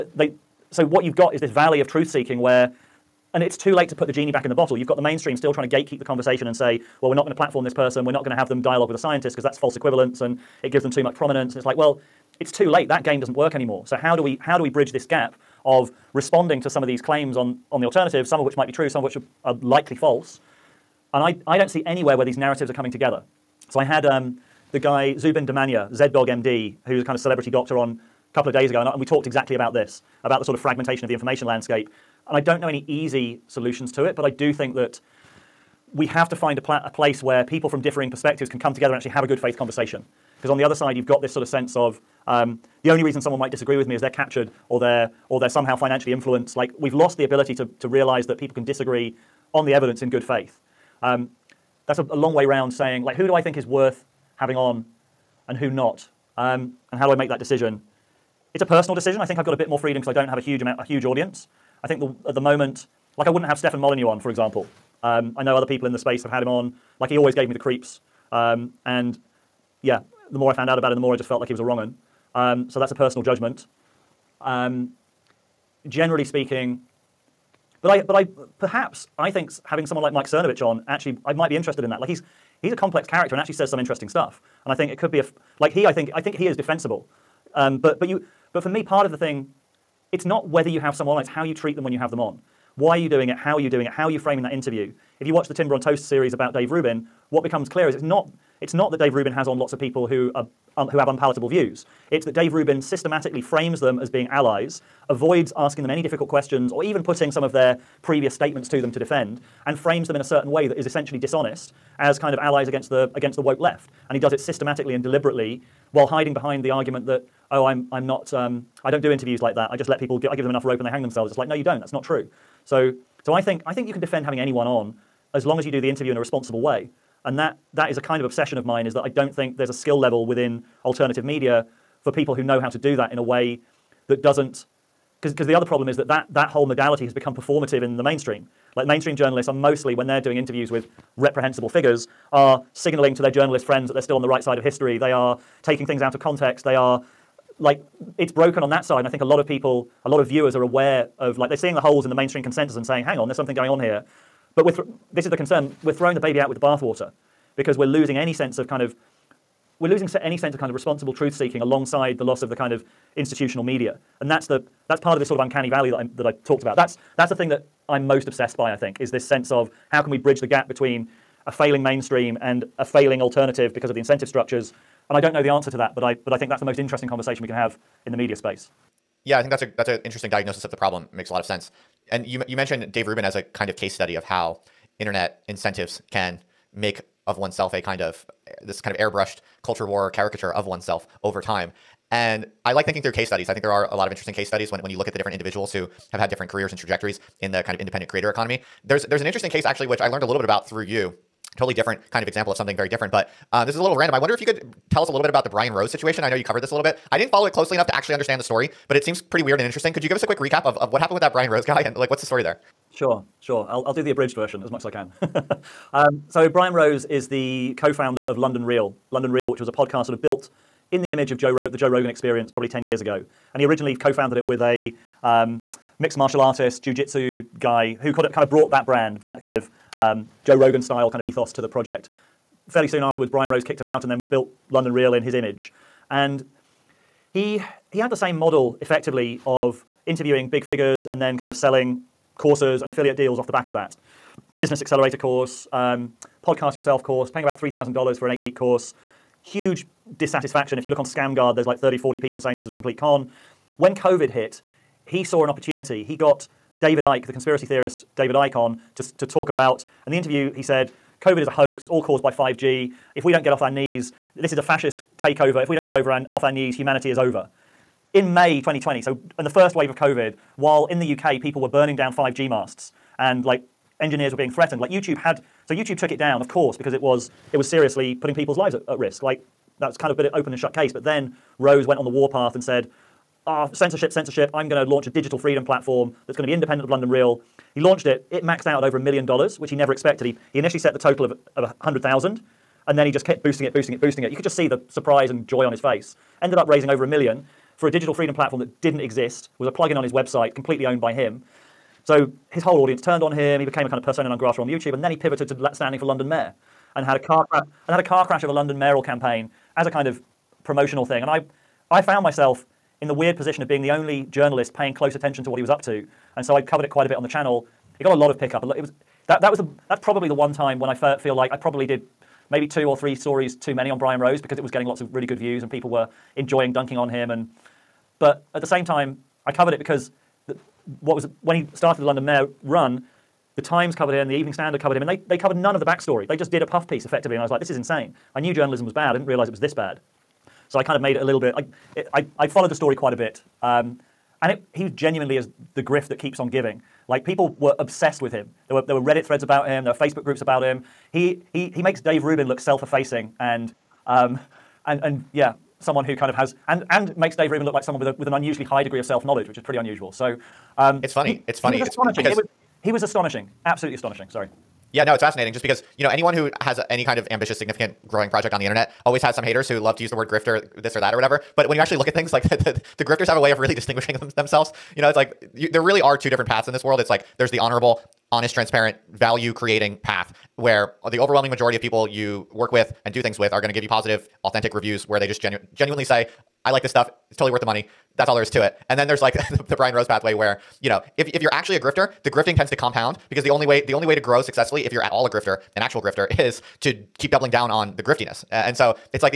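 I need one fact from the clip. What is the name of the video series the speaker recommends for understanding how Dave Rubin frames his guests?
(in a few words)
Timber on Toast.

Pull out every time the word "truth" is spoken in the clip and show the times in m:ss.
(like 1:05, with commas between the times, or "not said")
0:01, 2:41.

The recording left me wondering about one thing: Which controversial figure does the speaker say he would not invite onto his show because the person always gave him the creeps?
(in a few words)
Stefan Molyneux.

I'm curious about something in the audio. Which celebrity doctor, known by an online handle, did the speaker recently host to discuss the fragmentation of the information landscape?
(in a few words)
ZDoggMD.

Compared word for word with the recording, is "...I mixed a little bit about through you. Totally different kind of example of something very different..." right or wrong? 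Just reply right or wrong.
wrong.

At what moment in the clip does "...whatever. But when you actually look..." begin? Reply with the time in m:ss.
6:11.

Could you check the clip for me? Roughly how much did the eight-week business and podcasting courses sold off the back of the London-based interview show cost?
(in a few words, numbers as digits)
$3,000.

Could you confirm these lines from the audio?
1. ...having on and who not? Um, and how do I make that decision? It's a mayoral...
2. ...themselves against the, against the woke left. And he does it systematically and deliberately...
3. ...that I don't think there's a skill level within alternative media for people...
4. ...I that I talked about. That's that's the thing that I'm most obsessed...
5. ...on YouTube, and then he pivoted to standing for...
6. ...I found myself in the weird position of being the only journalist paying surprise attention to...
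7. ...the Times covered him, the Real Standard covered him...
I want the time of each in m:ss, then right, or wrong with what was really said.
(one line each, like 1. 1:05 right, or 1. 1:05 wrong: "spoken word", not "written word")
1. 0:54 wrong: "personal", not "mayoral"
2. 1:52 wrong: "allies", not "themselves"
3. 2:08 right
4. 2:45 right
5. 5:04 right
6. 5:11 wrong: "close", not "surprise"
7. 5:33 wrong: "Evening", not "Real".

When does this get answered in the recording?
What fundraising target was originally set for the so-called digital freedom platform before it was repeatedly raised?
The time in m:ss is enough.
4:51.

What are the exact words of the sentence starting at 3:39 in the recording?
London Real, which was a podcast sort of built in the image of Joe the Joe Rogan Experience probably 10 years ago.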